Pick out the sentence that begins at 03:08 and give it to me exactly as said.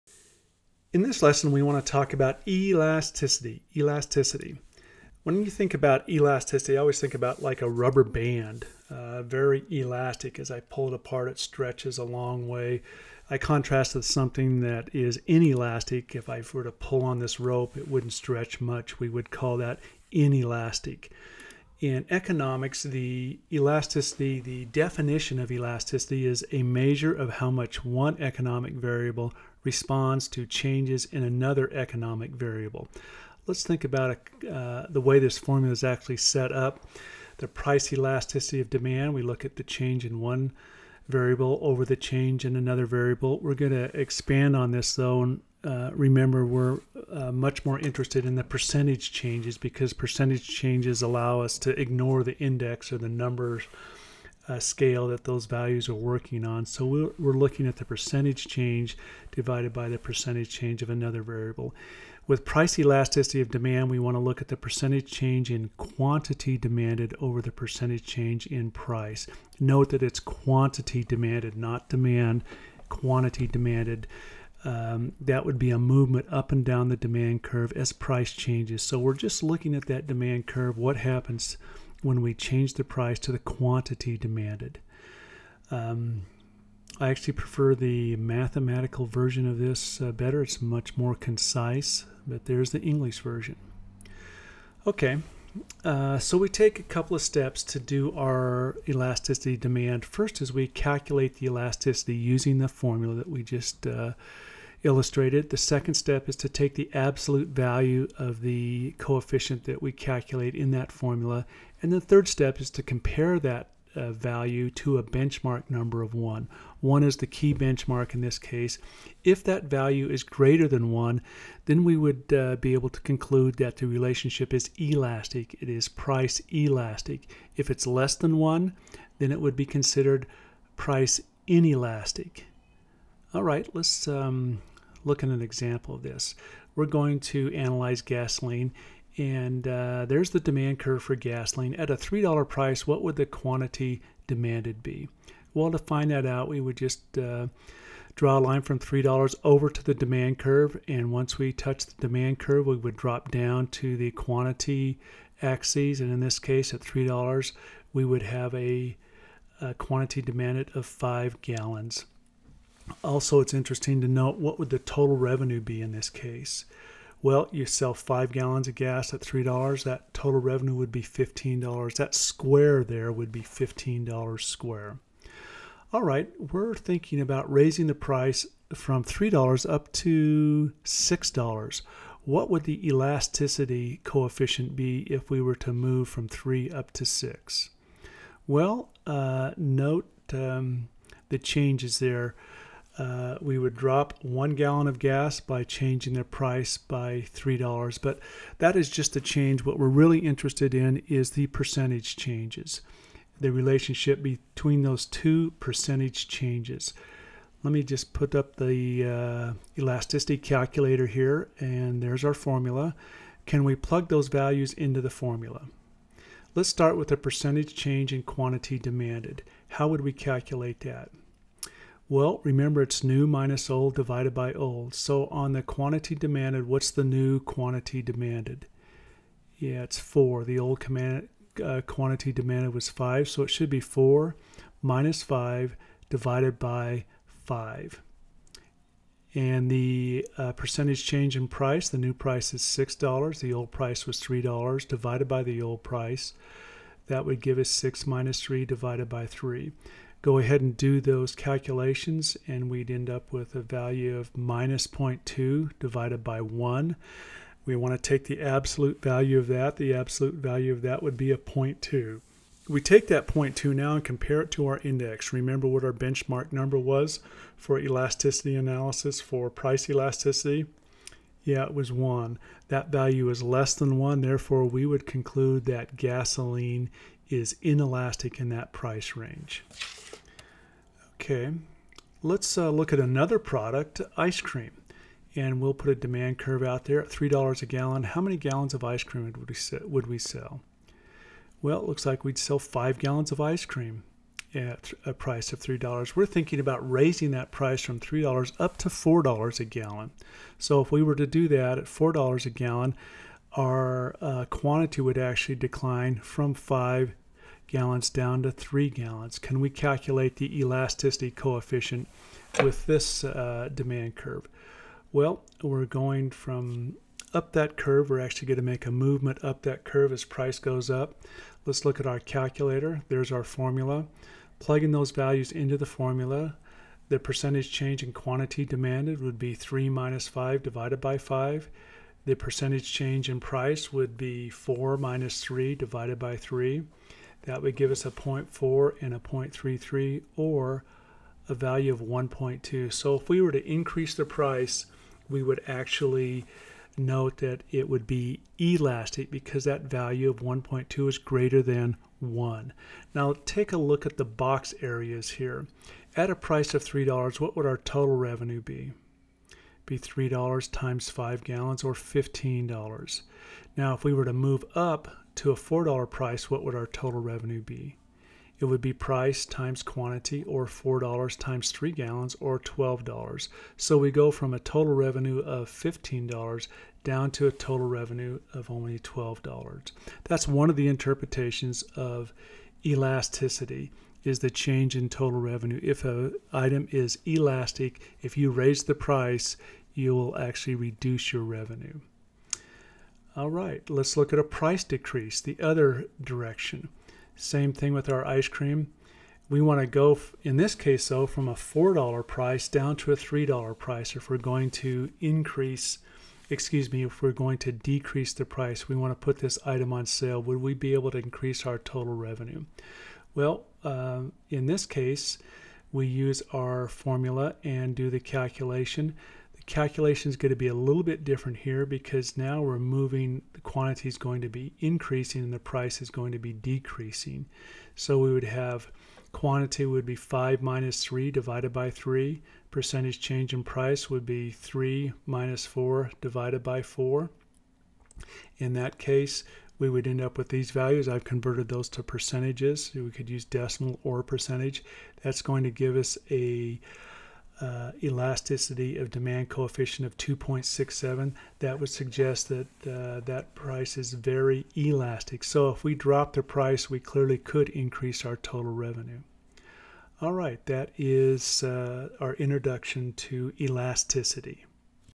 Well, uh, note um, the changes there uh, we would drop one gallon of gas by changing their price by $3.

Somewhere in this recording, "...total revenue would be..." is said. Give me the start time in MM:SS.
02:50.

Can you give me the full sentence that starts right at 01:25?
Um, I actually prefer the mathematical version of this uh, better.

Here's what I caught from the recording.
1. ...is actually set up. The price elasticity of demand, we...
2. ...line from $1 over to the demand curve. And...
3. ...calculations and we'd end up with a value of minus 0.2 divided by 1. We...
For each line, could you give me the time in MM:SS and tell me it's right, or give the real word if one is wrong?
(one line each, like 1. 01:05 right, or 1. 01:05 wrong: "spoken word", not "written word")
1. 00:35 right
2. 02:28 wrong: "3", not "1"
3. 04:11 right.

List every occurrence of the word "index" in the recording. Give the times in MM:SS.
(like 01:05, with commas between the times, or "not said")
00:52, 04:24.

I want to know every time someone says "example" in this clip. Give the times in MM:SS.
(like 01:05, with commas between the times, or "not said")
02:15.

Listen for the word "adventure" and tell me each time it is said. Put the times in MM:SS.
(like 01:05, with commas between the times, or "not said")
not said.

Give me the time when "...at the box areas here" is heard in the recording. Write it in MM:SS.
05:54.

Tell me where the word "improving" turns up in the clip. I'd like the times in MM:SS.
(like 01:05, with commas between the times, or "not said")
not said.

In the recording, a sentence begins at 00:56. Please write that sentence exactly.
So we're, we're looking at the percentage change divided by the percentage change of another variable.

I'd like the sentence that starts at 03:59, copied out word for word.
And the uh, percentage change in price, the new price is $6.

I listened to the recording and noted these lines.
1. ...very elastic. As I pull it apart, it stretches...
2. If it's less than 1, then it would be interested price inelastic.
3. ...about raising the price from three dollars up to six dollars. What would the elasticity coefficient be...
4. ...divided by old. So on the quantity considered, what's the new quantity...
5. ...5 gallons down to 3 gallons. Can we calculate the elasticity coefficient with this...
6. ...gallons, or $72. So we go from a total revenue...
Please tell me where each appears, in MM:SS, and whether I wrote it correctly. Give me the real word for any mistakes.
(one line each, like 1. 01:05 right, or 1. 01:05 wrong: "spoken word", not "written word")
1. 00:09 right
2. 02:07 wrong: "considered", not "interested"
3. 02:57 right
4. 03:43 wrong: "demanded", not "considered"
5. 05:06 right
6. 06:11 wrong: "12", not "72".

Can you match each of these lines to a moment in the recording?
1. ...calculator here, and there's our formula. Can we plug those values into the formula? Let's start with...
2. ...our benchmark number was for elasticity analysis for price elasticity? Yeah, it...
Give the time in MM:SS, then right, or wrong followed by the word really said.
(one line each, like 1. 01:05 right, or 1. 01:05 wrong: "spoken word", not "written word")
1. 03:30 right
2. 04:25 right.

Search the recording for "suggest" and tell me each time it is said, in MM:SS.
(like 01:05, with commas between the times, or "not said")
07:31.